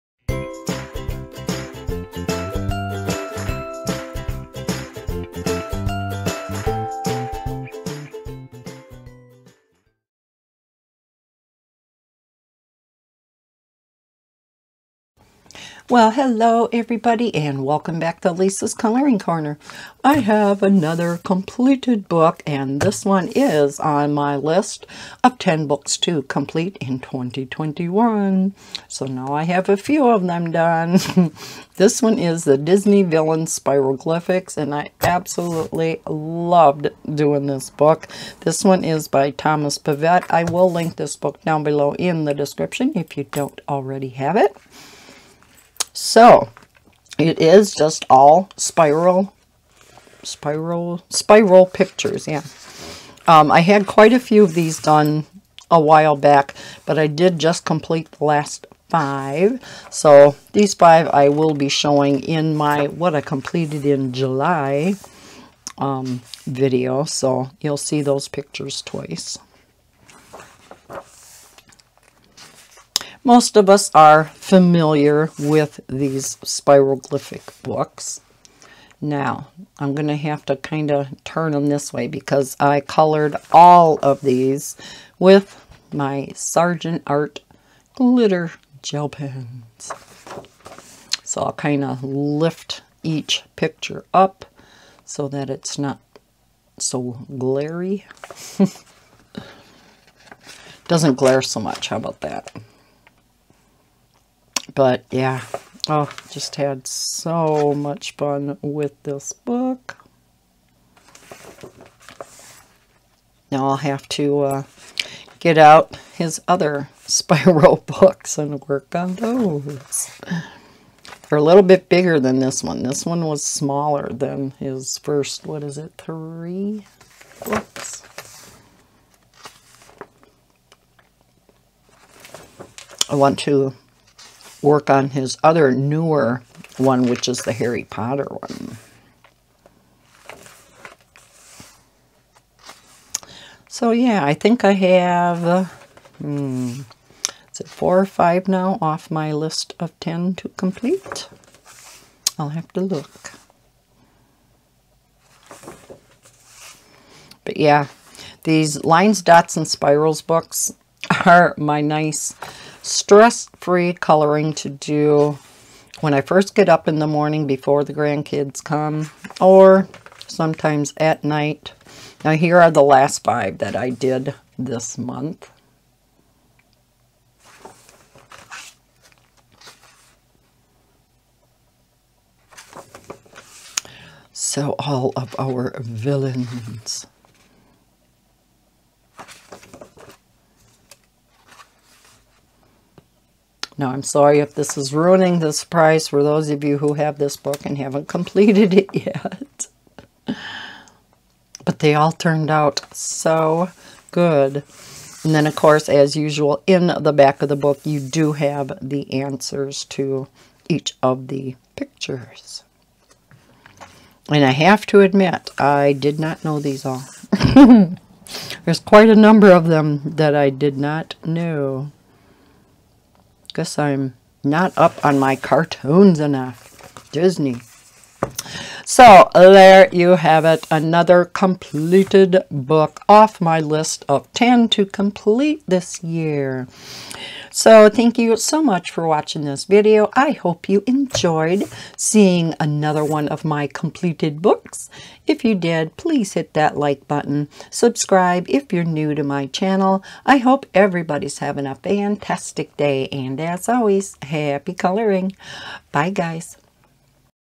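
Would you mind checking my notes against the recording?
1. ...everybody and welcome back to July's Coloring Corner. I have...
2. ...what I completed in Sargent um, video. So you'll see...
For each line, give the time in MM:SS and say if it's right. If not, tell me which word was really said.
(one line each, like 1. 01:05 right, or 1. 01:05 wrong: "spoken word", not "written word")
1. 00:16 wrong: "Lisa", not "July"
2. 01:02 wrong: "July", not "Sargent".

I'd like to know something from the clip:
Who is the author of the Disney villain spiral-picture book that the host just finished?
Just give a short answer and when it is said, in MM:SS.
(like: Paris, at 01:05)
Thomas Pavitte, at 00:39.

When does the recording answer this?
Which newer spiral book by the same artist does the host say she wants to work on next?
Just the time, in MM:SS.
02:17.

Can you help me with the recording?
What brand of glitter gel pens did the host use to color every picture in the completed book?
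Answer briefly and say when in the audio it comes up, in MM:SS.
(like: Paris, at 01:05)
Sargent Art, at 01:26.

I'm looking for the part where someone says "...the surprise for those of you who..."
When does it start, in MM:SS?
03:15.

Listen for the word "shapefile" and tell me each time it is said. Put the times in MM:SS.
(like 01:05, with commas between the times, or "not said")
not said.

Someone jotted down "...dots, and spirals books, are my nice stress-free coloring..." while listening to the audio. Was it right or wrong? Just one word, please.
right.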